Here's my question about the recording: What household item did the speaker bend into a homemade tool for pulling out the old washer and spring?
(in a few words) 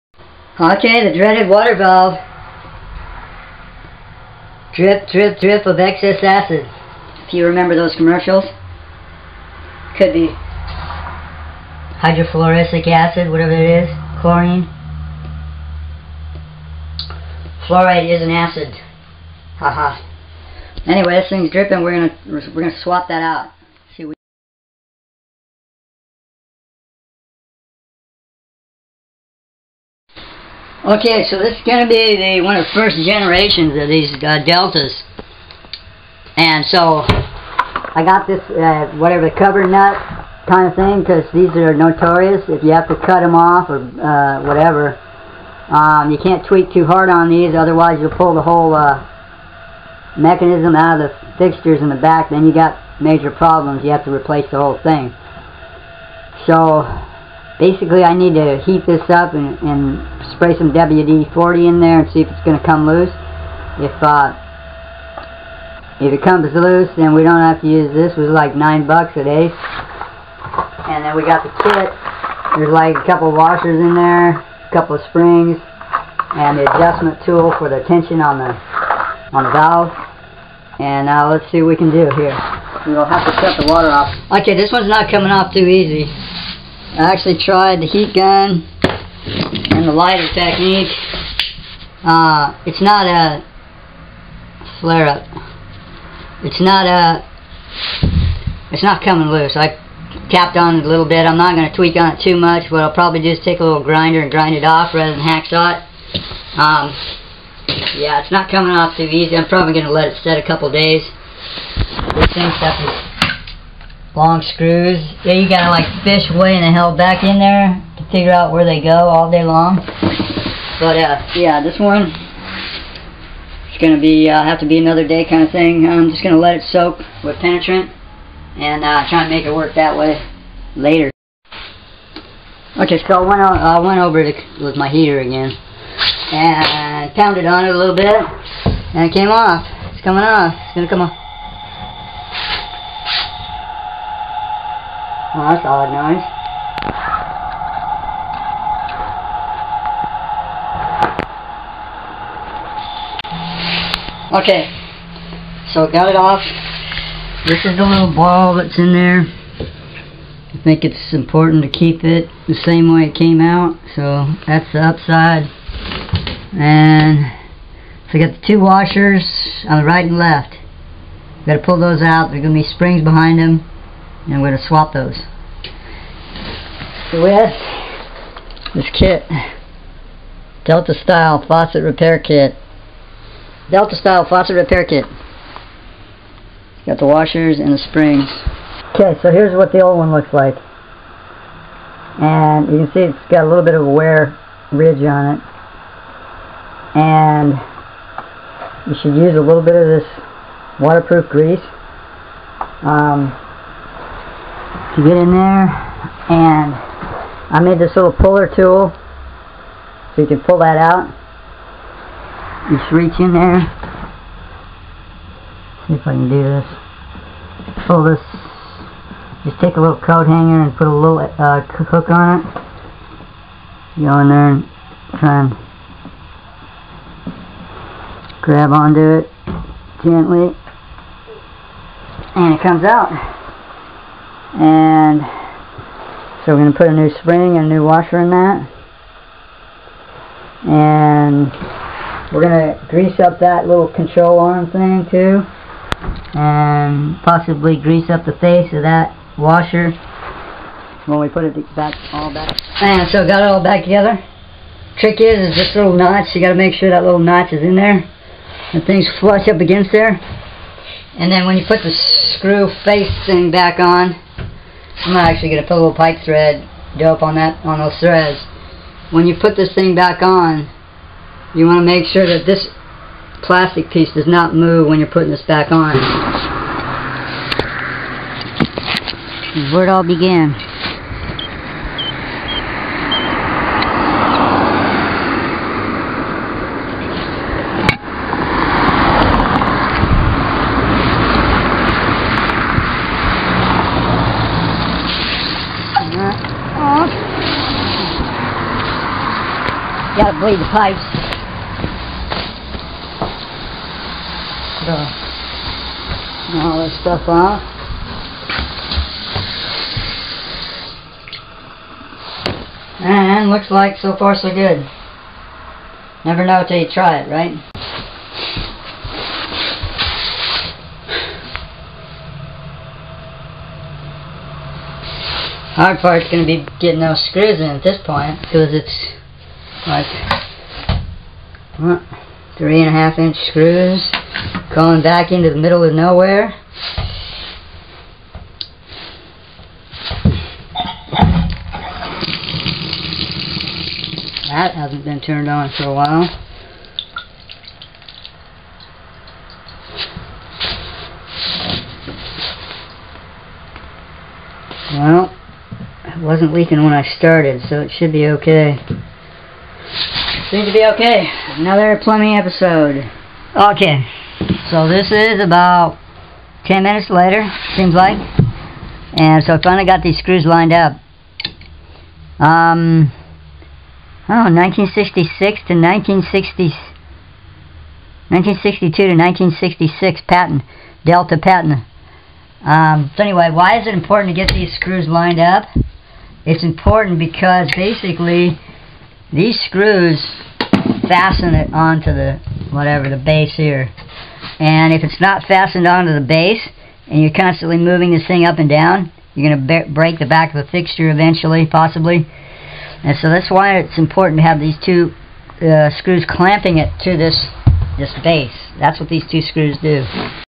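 coat hanger.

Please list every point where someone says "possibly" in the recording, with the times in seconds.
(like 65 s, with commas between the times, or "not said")
247 s, 401 s.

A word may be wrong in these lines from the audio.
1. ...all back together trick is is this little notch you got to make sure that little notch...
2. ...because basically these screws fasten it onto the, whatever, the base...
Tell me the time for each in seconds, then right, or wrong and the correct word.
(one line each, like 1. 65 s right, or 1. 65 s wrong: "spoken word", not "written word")
1. 253 s right
2. 387 s right.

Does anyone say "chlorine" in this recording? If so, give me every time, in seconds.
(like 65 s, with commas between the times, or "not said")
14 s.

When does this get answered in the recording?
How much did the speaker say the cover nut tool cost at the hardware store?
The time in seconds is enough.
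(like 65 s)
68 s.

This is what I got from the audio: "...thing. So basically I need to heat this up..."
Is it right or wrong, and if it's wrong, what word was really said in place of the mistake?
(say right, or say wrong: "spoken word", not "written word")
right.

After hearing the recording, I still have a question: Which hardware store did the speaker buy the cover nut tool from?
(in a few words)
Ace.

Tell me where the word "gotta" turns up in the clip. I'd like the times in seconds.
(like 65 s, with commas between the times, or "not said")
115 s, 300 s.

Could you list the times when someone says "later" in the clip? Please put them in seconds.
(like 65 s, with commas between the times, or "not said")
130 s, 367 s.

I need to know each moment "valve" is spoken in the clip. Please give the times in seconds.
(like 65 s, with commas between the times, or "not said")
1 s, 79 s.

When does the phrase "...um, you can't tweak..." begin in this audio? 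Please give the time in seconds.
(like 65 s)
45 s.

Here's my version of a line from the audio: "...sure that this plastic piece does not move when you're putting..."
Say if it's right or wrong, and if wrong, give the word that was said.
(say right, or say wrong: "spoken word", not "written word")
right.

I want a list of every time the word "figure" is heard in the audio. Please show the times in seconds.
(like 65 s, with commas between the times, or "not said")
118 s.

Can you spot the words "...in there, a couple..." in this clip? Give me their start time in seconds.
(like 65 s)
73 s.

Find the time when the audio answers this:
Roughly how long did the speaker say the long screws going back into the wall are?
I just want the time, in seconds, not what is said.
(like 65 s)
332 s.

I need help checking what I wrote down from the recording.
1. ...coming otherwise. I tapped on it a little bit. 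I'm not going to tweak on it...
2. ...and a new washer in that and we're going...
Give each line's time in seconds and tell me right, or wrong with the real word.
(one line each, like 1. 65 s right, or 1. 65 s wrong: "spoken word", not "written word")
1. 99 s wrong: "loose", not "otherwise"
2. 237 s right.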